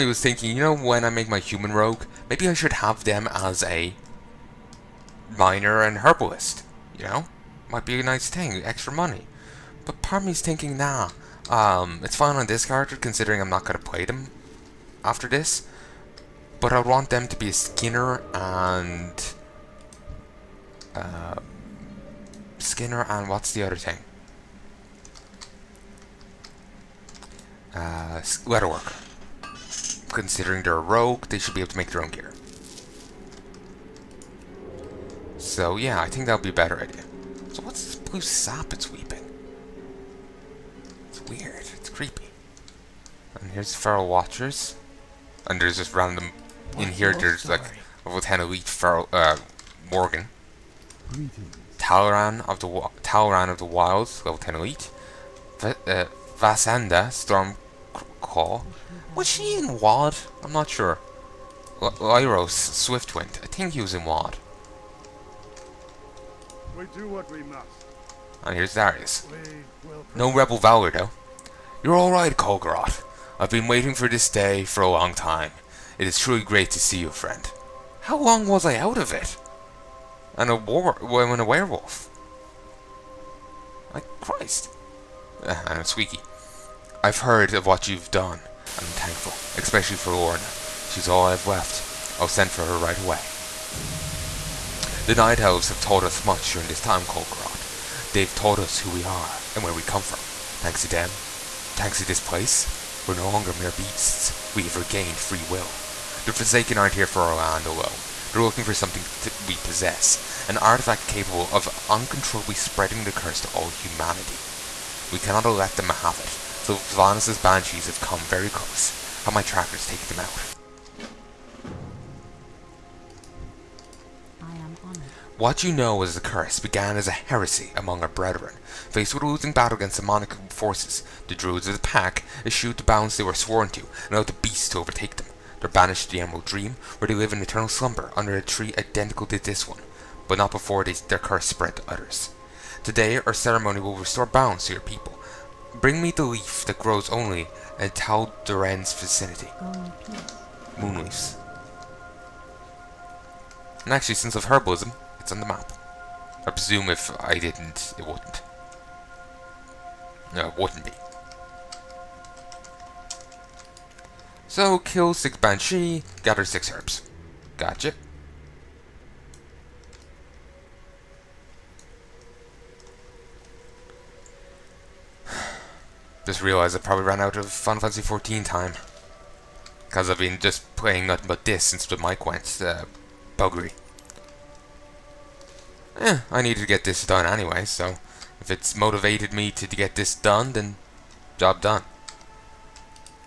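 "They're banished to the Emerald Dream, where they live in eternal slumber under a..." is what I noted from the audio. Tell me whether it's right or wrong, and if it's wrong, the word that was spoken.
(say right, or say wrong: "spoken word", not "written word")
right.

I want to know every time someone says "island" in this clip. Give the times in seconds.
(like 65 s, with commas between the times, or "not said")
not said.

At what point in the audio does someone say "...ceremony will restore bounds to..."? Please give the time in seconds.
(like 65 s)
143 s.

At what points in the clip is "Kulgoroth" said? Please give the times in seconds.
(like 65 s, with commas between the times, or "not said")
72 s, 97 s.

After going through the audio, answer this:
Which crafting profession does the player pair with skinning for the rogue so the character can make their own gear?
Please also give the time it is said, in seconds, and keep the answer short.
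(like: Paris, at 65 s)
Leatherworker, at 28 s.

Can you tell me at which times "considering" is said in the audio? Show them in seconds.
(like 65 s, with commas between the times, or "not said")
12 s, 30 s.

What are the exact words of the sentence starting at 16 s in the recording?
But I want them to be a Skinner and...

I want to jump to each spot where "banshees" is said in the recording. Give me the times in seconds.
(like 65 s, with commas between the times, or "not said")
117 s, 165 s.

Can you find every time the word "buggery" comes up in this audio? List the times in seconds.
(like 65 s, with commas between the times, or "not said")
183 s.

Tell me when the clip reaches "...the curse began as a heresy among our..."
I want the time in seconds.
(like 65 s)
126 s.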